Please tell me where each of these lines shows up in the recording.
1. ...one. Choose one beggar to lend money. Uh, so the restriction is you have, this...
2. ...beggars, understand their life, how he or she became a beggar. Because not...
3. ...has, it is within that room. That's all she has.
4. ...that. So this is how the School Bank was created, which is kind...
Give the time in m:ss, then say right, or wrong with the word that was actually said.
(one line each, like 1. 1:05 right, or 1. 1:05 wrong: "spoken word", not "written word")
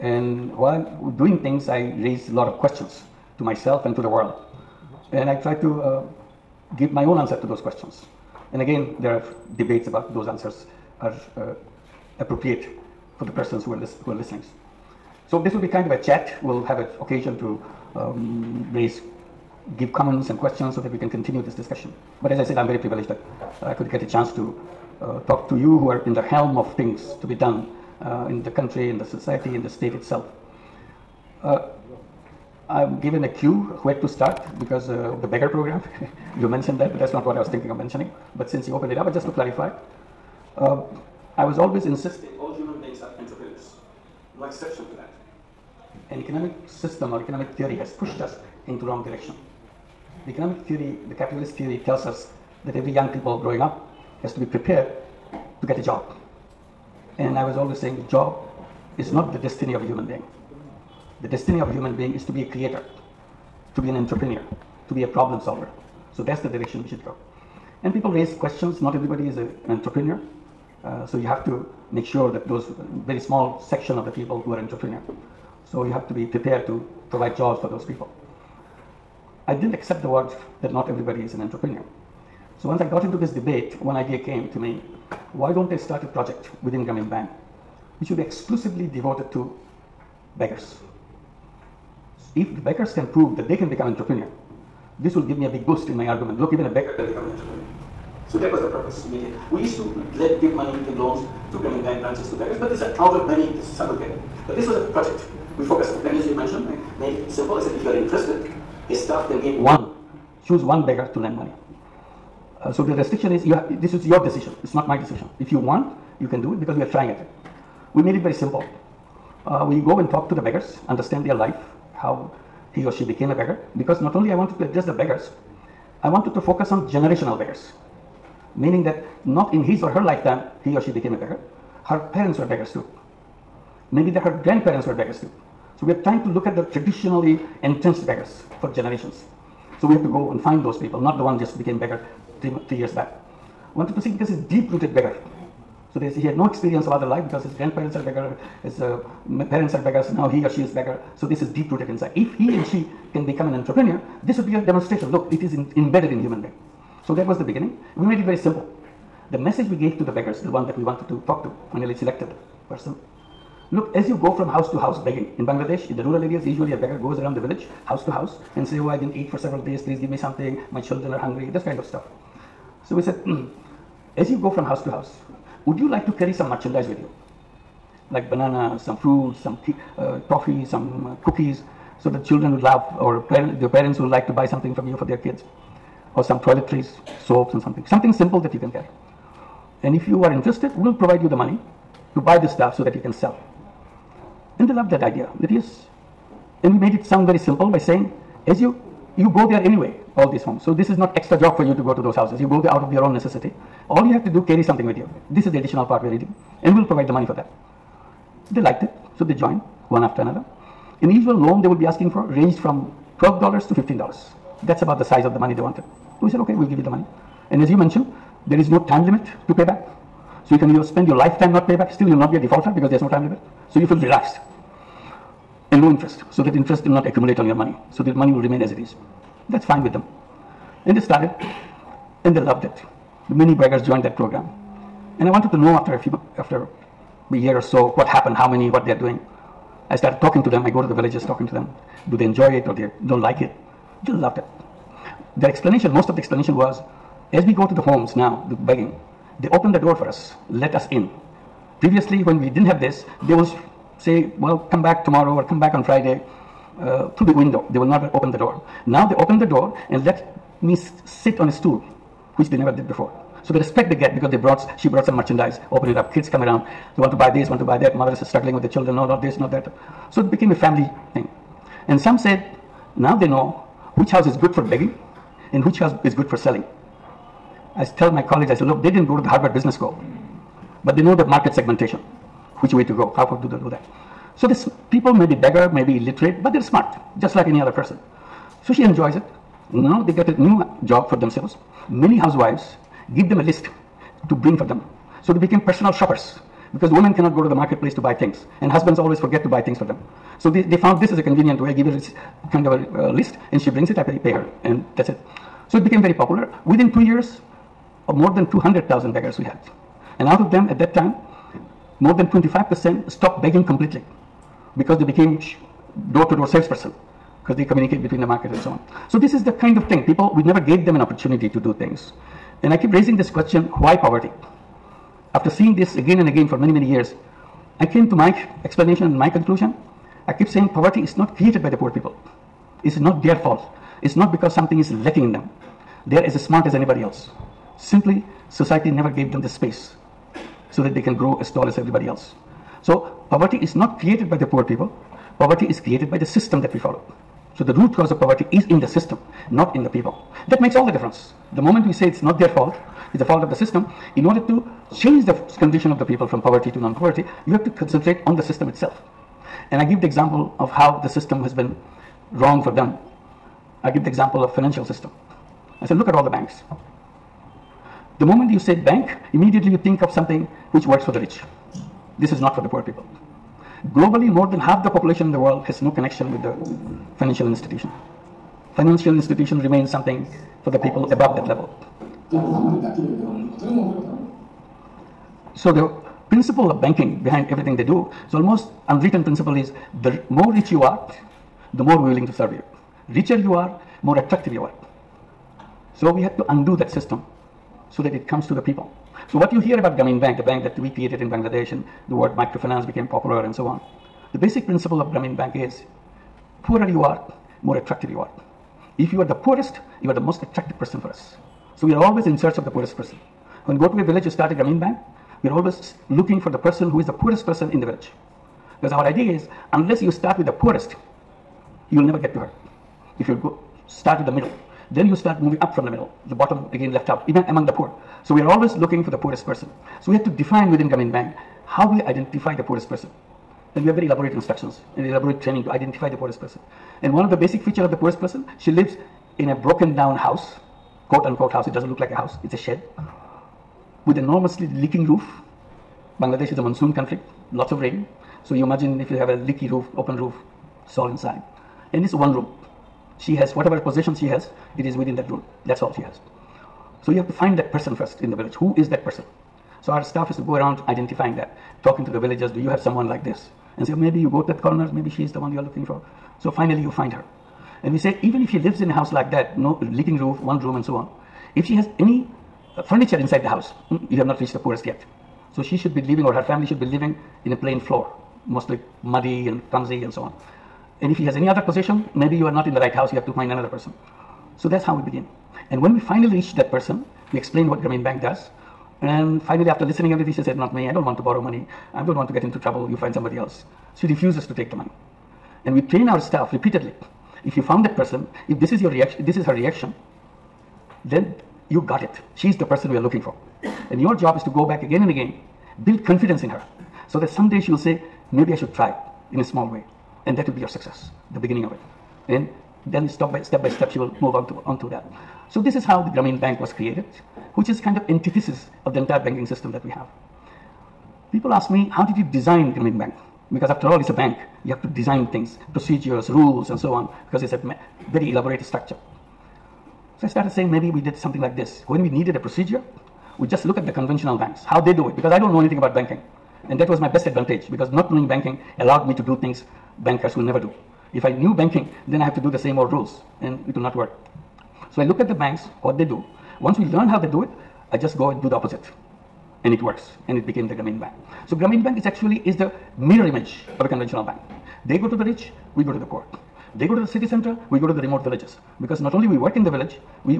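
1. 1:49 right
2. 2:00 right
3. 7:34 right
4. 8:34 wrong: "Grameen", not "School".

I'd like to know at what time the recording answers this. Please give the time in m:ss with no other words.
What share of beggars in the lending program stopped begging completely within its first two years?
5:12.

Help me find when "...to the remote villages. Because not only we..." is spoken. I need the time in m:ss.
9:17.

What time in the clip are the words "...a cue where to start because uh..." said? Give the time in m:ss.
0:33.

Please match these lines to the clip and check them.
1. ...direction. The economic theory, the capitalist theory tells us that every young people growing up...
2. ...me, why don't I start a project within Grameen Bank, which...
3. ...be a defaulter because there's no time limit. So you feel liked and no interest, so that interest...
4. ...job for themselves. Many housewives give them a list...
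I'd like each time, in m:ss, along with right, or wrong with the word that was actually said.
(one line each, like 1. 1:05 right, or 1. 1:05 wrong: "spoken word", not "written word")
1. 0:49 right
2. 1:24 right
3. 3:42 wrong: "relaxed", not "liked"
4. 4:50 right.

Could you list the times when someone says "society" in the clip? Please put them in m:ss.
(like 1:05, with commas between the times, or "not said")
0:29, 5:38.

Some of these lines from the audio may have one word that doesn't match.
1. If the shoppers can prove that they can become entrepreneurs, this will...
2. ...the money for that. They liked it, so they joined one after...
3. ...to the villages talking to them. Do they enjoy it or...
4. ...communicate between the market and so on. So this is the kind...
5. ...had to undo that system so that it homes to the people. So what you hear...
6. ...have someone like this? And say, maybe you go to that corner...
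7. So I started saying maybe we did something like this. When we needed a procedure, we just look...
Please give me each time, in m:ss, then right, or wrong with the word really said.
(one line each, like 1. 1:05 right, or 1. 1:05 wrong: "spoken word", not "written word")
1. 1:32 wrong: "beggars", not "shoppers"
2. 3:27 right
3. 4:00 right
4. 5:17 right
5. 6:36 wrong: "comes", not "homes"
6. 7:42 right
7. 8:50 right.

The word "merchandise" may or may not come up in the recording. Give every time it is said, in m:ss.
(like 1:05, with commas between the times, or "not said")
2:56, 4:25.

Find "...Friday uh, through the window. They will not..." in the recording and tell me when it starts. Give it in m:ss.
4:15.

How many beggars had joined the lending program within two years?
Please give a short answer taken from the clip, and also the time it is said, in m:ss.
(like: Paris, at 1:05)
200,000, at 5:08.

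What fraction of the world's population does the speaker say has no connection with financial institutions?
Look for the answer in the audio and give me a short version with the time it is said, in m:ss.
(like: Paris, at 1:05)
More than half, at 6:14.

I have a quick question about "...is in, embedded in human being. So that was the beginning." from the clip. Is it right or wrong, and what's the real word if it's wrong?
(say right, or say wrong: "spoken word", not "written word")
right.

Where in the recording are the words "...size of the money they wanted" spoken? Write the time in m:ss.
3:35.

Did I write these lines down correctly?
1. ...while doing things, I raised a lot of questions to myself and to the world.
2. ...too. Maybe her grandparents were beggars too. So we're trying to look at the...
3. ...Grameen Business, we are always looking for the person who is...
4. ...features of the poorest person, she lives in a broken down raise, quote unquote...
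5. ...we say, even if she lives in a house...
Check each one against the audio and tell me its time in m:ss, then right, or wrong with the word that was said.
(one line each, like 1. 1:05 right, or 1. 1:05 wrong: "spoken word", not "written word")
1. 0:00 right
2. 2:12 right
3. 6:54 wrong: "Bank", not "Business"
4. 7:17 wrong: "house", not "raise"
5. 7:47 right.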